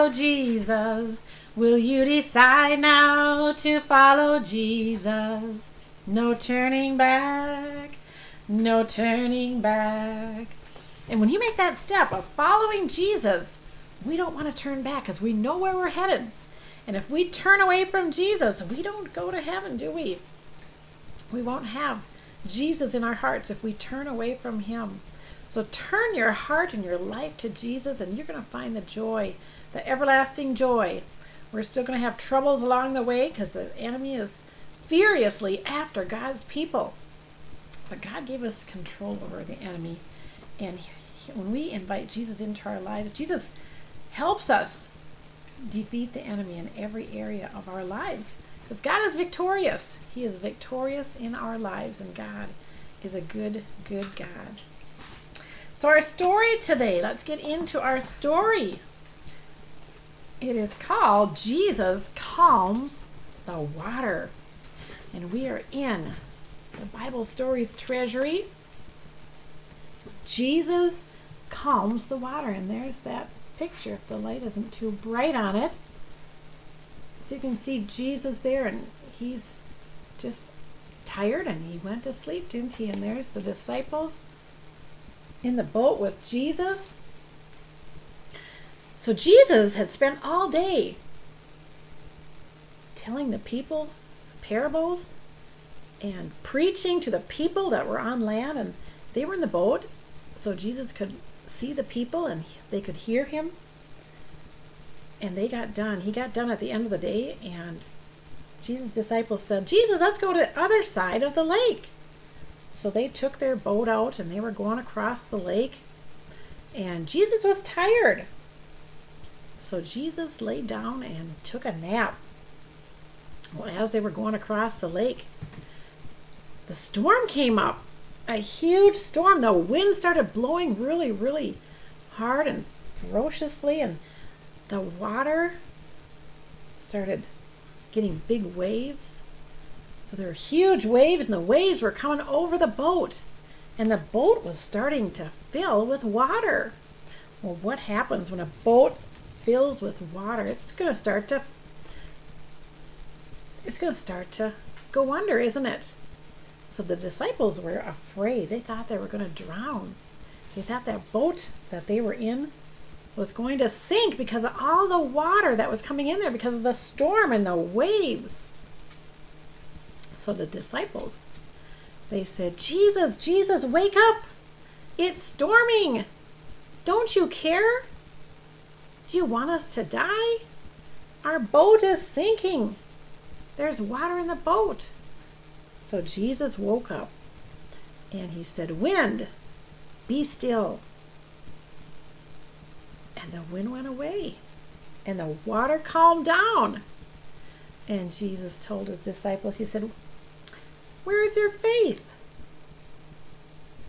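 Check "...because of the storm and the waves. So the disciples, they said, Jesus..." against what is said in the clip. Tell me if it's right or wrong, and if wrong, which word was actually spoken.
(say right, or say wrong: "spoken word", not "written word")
right.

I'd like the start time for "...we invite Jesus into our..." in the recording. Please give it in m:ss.
0:41.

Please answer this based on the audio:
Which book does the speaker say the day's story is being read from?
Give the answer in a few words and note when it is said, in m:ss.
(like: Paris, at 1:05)
Bible Stories Treasury, at 1:06.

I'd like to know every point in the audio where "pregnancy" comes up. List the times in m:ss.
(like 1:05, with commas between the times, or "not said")
not said.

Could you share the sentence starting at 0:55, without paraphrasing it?
So, our story today, let's get into our story.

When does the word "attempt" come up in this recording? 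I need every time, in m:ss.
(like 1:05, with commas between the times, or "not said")
not said.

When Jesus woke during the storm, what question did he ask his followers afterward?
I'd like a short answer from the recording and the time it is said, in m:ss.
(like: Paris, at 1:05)
Where is your faith?, at 3:21.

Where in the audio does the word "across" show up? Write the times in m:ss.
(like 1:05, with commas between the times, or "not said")
1:54, 2:04.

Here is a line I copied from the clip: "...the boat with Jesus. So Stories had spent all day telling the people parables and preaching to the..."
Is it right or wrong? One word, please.
wrong.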